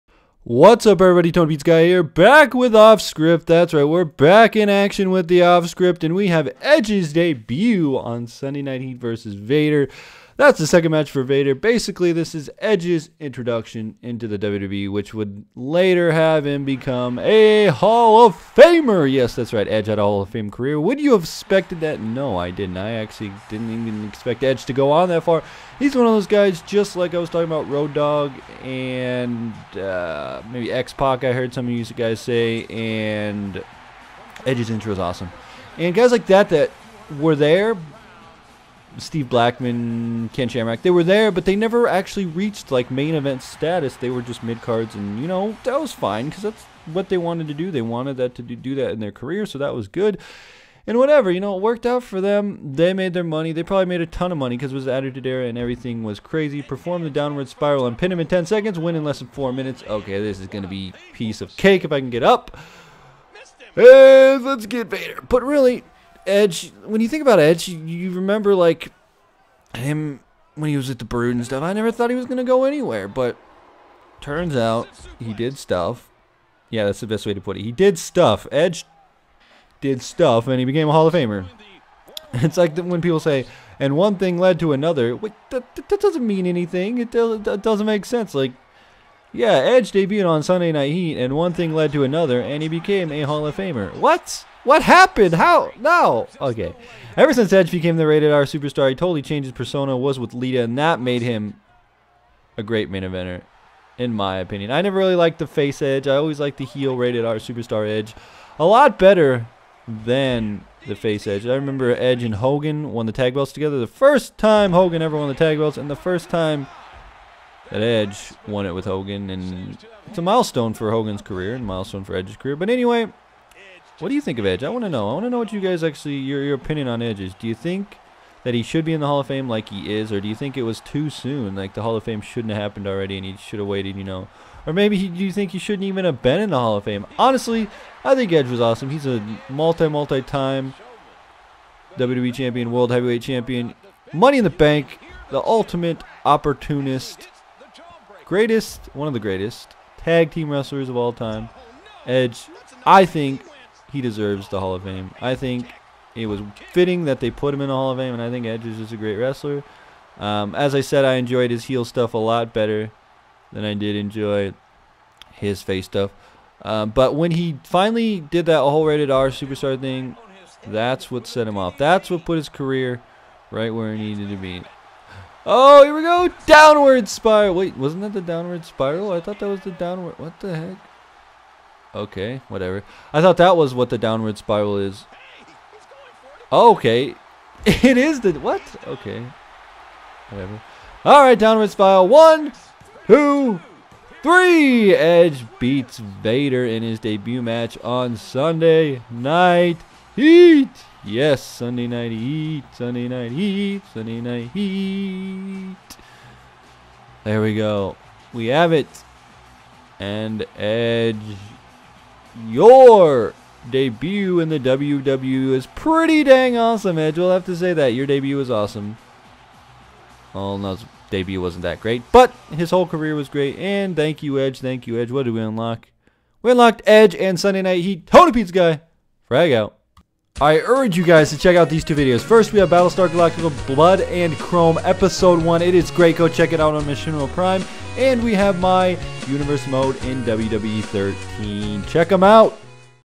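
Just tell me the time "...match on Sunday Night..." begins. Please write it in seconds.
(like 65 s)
197 s.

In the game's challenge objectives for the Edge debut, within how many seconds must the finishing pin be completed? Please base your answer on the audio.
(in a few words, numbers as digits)
10 seconds.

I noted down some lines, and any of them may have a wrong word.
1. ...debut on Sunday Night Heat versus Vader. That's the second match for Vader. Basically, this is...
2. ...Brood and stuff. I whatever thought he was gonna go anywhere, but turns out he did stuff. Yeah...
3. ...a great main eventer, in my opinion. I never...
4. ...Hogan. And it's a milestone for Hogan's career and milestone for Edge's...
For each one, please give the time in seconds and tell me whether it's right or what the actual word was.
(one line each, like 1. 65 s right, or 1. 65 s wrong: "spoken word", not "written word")
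1. 7 s right
2. 71 s wrong: "never", not "whatever"
3. 102 s right
4. 118 s right.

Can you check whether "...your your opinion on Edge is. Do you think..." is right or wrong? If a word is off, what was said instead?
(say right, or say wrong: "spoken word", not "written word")
right.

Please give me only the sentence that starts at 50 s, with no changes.
And whatever, you know, it worked out for them.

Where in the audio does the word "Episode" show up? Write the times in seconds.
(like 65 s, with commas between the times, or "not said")
234 s.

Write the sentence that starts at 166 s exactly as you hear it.
Um, but when he finally did that whole rated R superstar thing, that's what set him off.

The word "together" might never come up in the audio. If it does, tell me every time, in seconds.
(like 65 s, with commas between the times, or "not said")
113 s.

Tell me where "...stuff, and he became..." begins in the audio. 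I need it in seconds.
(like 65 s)
80 s.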